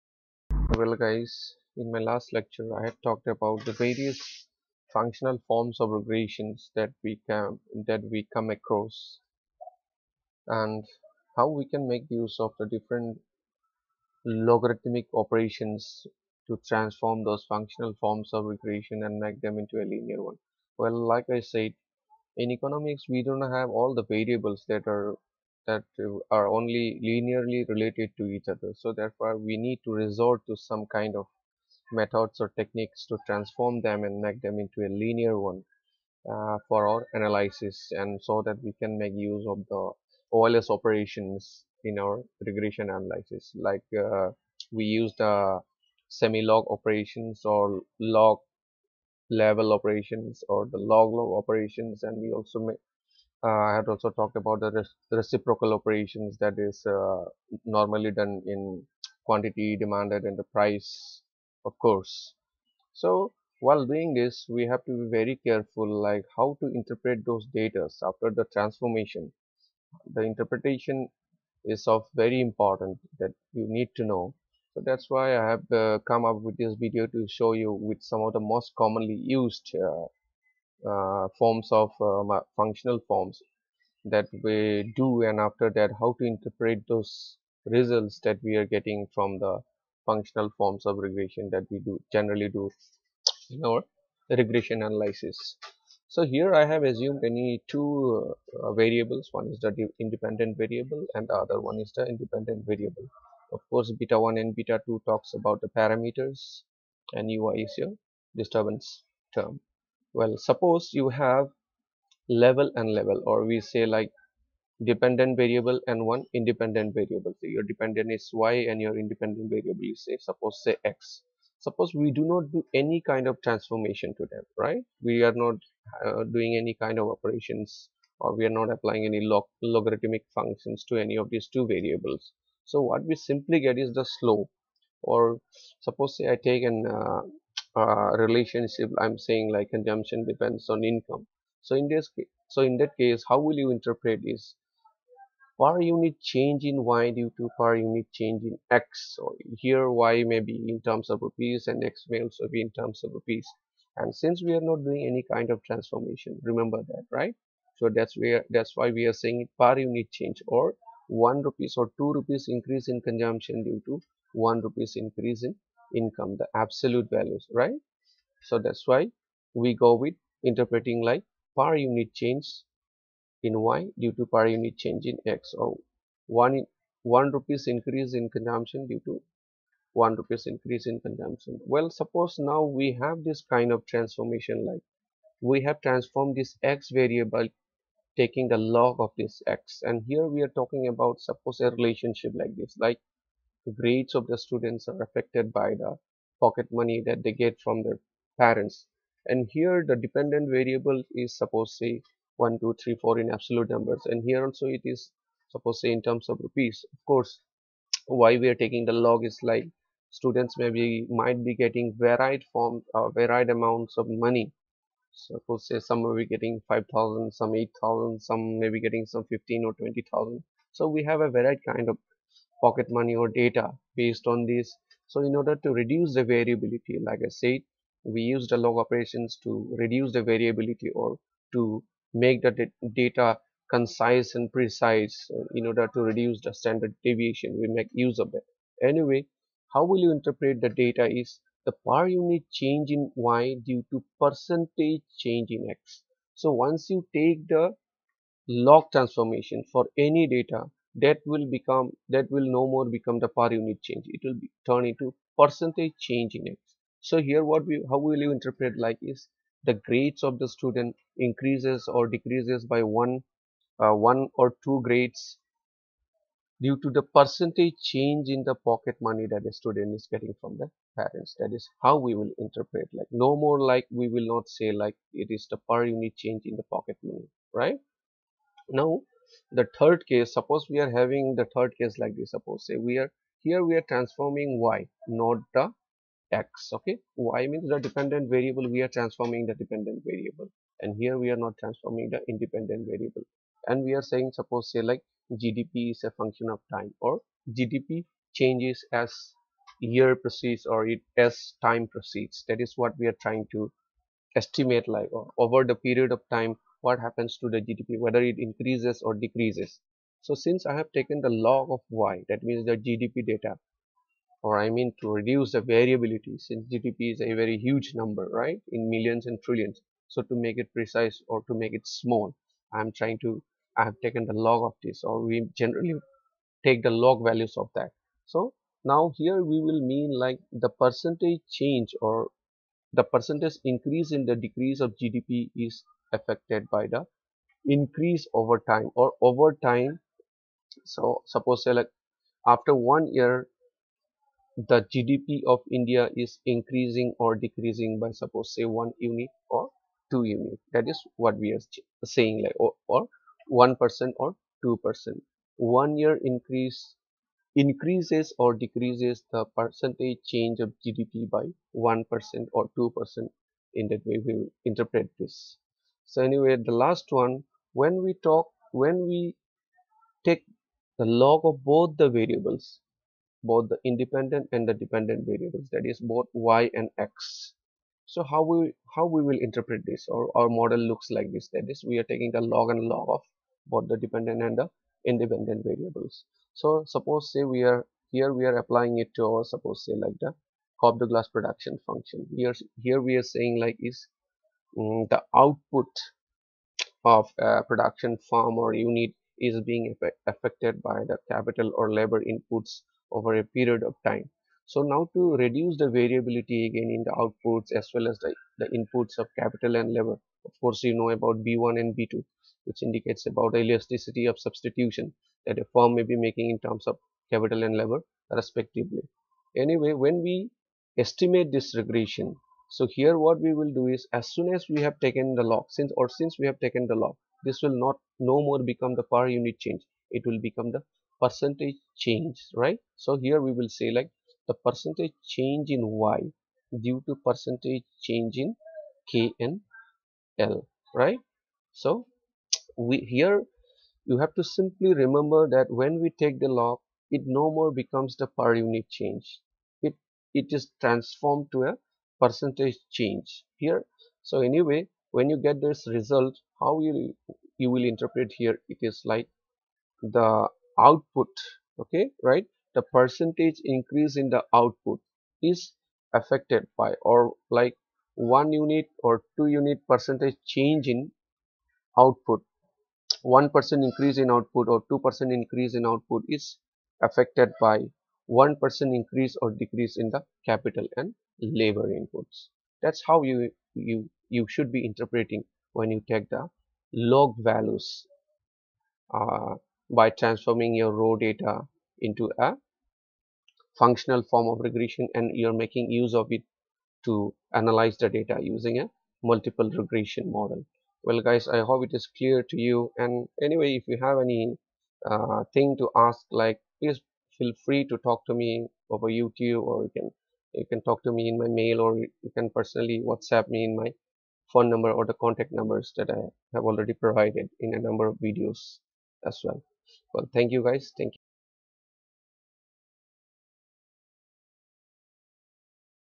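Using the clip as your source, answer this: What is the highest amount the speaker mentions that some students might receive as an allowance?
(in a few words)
20000.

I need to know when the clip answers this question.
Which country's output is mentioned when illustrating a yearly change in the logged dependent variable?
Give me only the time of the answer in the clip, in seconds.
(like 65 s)
345 s.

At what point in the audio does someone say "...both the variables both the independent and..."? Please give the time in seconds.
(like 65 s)
371 s.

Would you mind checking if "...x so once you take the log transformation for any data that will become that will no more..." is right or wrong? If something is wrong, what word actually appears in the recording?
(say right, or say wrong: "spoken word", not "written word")
right.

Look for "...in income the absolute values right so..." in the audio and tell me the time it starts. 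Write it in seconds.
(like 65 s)
165 s.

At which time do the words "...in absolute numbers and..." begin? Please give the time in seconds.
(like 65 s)
203 s.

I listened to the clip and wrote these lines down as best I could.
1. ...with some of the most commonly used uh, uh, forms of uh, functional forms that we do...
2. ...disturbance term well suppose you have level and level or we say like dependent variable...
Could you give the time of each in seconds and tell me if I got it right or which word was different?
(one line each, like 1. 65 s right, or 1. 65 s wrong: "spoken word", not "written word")
1. 77 s right
2. 108 s right.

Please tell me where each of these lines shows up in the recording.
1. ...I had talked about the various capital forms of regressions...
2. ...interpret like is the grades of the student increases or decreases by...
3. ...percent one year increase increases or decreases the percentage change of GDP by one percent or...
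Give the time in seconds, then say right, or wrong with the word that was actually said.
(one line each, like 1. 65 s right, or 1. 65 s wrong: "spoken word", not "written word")
1. 2 s wrong: "functional", not "capital"
2. 258 s right
3. 354 s right.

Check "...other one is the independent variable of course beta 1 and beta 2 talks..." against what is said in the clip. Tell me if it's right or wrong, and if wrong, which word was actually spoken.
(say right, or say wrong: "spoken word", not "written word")
right.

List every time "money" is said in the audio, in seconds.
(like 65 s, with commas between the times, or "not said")
196 s, 214 s, 222 s, 269 s, 277 s.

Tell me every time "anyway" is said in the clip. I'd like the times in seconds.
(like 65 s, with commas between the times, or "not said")
238 s, 366 s, 419 s, 454 s, 503 s.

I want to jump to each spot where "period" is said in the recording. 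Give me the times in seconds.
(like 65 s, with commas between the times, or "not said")
305 s, 403 s.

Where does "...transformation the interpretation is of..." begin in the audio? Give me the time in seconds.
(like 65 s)
68 s.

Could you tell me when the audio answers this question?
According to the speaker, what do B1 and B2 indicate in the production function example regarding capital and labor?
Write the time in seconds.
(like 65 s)
413 s.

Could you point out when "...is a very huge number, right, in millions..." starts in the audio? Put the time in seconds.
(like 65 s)
317 s.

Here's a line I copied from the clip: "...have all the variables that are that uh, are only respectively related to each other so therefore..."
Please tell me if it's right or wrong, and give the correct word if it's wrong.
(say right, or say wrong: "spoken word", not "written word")
wrong: "linearly", not "respectively".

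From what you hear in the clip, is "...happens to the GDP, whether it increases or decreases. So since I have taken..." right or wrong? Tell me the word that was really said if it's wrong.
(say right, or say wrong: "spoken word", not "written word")
right.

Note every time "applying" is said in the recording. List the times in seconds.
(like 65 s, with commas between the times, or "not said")
128 s, 388 s.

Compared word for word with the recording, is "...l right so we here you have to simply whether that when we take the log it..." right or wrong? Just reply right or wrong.
wrong.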